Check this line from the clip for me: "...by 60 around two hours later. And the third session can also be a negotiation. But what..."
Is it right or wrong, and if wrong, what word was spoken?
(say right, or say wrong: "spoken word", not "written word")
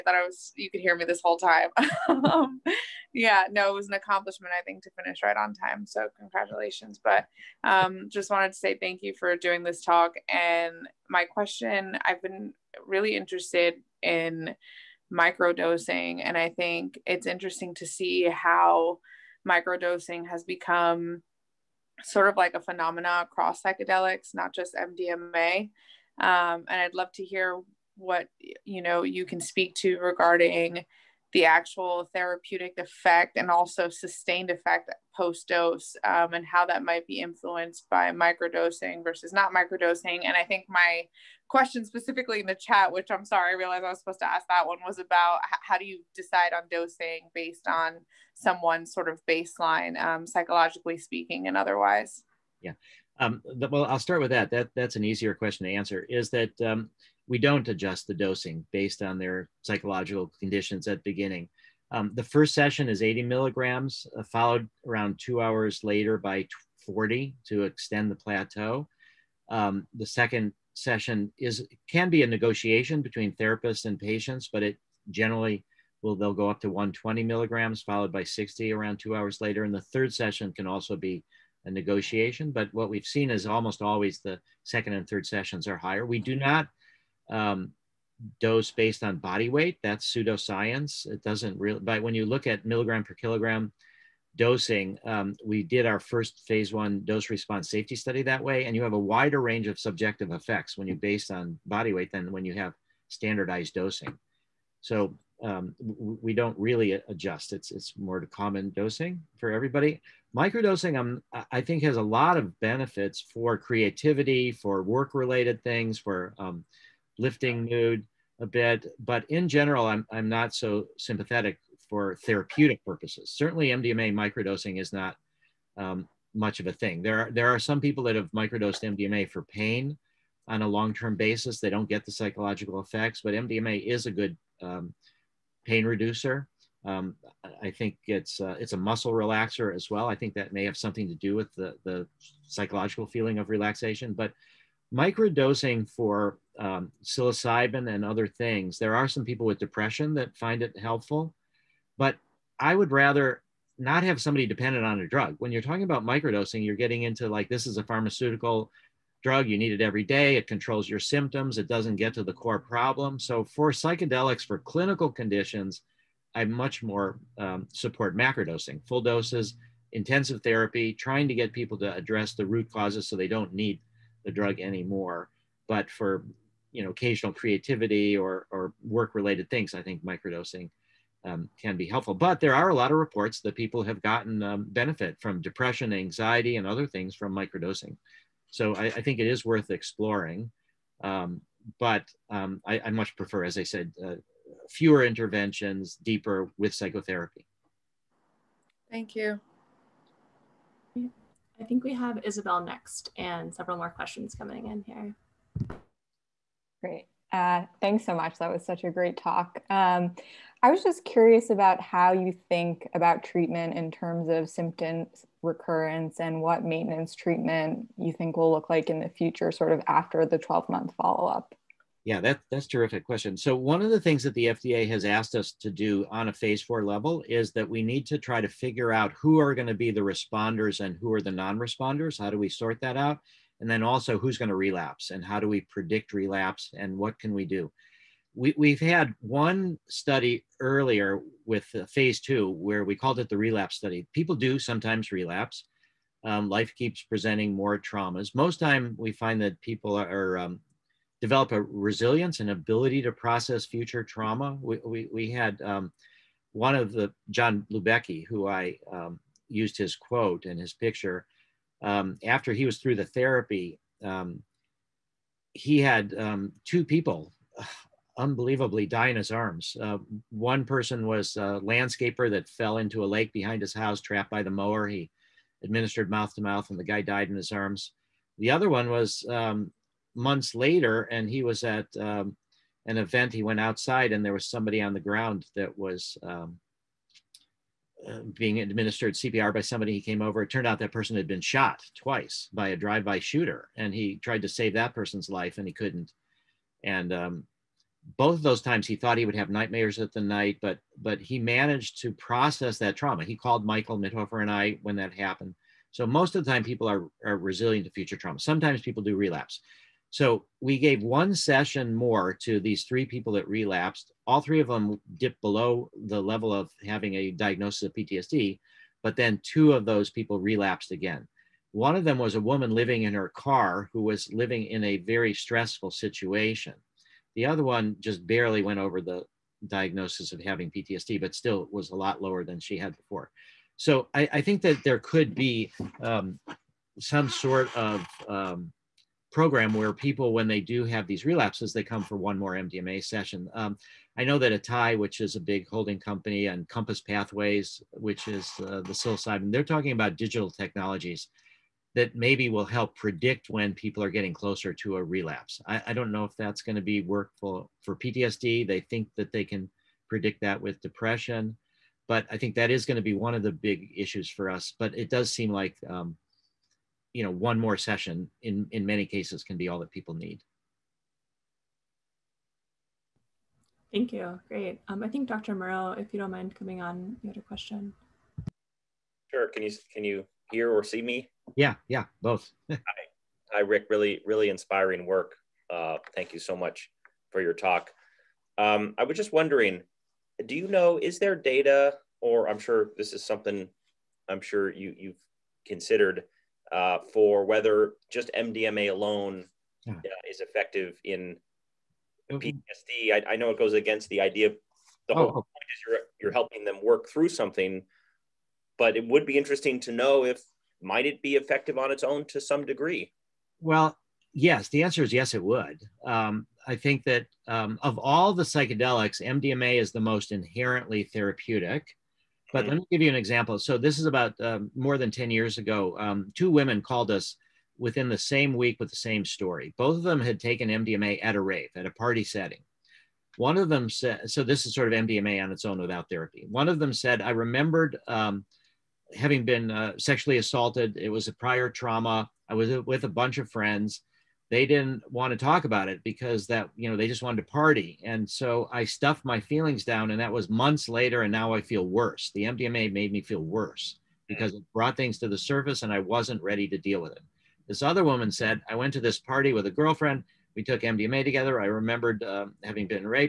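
right.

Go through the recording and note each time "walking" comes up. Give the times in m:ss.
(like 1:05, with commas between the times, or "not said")
not said.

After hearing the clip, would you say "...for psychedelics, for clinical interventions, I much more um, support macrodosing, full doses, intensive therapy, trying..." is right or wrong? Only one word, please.
wrong.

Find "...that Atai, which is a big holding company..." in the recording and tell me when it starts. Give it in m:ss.
5:44.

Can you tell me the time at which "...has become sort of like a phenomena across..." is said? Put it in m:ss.
0:20.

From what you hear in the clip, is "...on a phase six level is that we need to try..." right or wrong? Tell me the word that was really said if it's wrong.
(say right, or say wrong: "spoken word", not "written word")
wrong: "four", not "six".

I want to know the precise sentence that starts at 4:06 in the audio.
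Um, life keeps presenting more traumas.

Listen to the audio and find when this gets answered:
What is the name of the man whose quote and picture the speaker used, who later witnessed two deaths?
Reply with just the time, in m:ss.
4:17.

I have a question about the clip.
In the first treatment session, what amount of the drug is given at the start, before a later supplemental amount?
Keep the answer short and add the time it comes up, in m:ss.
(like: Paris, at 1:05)
80 milligrams, at 1:03.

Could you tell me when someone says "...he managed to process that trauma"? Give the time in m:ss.
5:01.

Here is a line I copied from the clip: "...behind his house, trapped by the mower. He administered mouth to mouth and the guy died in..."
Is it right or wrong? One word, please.
right.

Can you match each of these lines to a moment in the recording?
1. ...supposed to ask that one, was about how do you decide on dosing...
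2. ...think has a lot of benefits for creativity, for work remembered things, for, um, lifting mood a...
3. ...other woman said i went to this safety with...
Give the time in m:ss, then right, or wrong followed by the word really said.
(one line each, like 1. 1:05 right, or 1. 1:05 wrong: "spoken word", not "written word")
1. 0:43 right
2. 1:51 wrong: "related", not "remembered"
3. 7:37 wrong: "party", not "safety".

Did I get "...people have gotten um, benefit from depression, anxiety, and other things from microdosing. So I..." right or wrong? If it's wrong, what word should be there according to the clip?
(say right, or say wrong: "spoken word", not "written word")
right.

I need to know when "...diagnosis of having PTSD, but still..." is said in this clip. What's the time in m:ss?
5:29.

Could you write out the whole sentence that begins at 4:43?
He went outside, and there was somebody on the ground that was um, uh, being administered CPR by somebody.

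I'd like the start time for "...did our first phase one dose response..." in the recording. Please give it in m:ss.
1:35.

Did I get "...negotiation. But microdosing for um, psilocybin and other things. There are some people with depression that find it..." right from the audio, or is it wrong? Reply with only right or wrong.
wrong.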